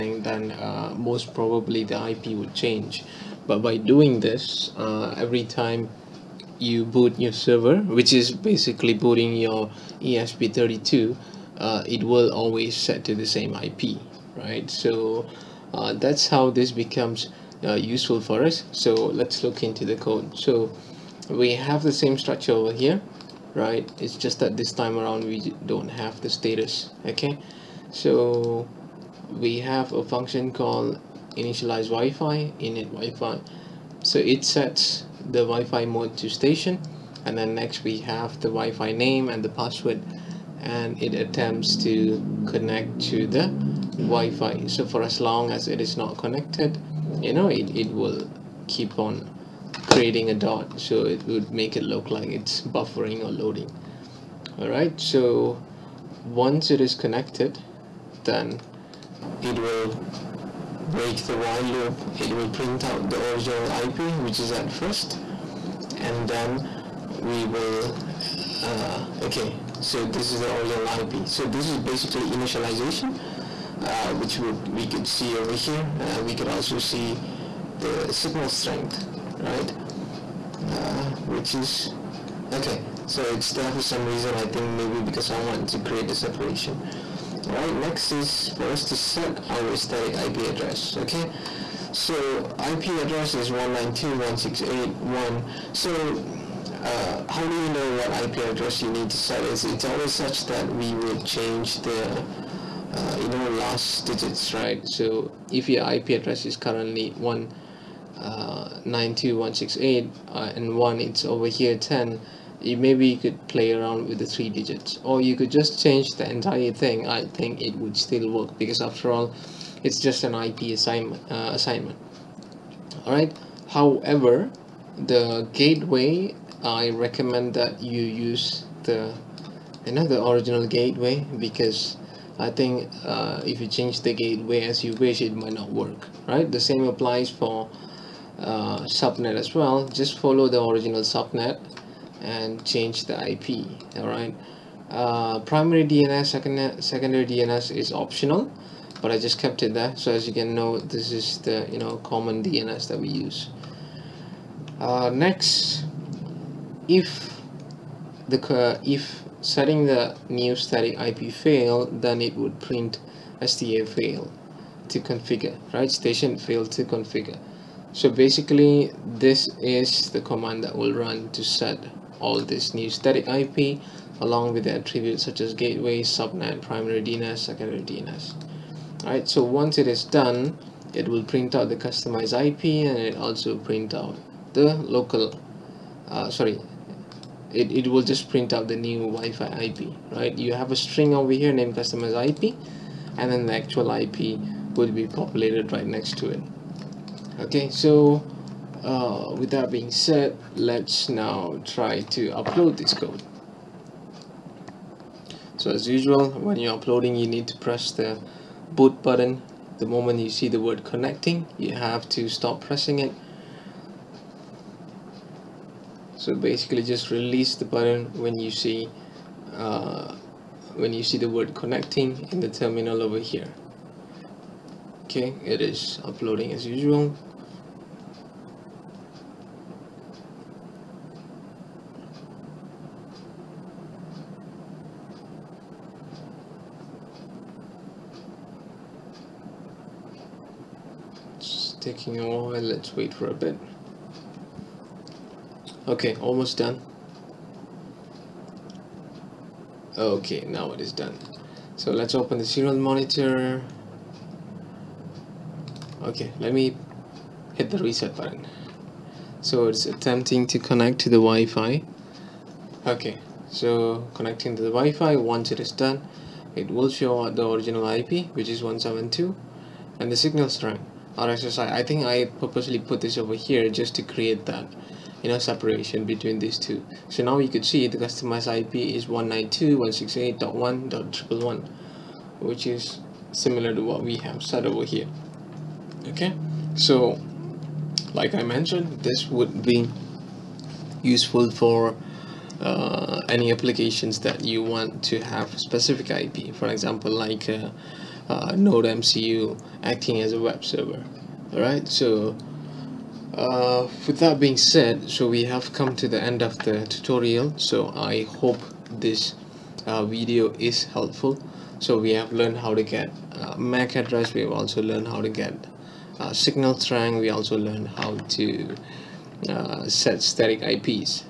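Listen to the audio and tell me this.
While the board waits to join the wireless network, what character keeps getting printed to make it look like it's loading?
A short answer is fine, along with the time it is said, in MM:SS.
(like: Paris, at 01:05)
a dot, at 00:50.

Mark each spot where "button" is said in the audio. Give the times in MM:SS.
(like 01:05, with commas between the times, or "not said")
03:29, 03:37, 04:18.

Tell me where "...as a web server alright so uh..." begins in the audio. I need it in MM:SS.
05:00.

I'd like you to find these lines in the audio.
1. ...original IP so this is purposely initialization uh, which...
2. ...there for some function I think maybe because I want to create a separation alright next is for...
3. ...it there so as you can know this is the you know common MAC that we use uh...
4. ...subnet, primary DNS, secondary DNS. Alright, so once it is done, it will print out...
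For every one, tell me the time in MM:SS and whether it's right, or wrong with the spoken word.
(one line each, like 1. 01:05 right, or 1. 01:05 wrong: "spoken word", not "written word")
1. 01:10 wrong: "basically", not "purposely"
2. 01:23 wrong: "reason", not "function"
3. 02:29 wrong: "DNS", not "MAC"
4. 02:56 right.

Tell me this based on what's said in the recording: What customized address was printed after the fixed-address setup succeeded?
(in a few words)
192.168.1.111.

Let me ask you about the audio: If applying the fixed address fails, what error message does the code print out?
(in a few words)
STA fail to configure.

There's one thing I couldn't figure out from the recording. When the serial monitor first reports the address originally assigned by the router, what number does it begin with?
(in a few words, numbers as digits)
172.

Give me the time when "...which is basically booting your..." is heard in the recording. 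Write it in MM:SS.
00:07.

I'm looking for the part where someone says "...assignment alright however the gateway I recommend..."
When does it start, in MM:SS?
02:01.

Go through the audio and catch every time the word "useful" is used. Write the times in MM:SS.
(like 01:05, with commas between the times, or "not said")
00:17, 04:51.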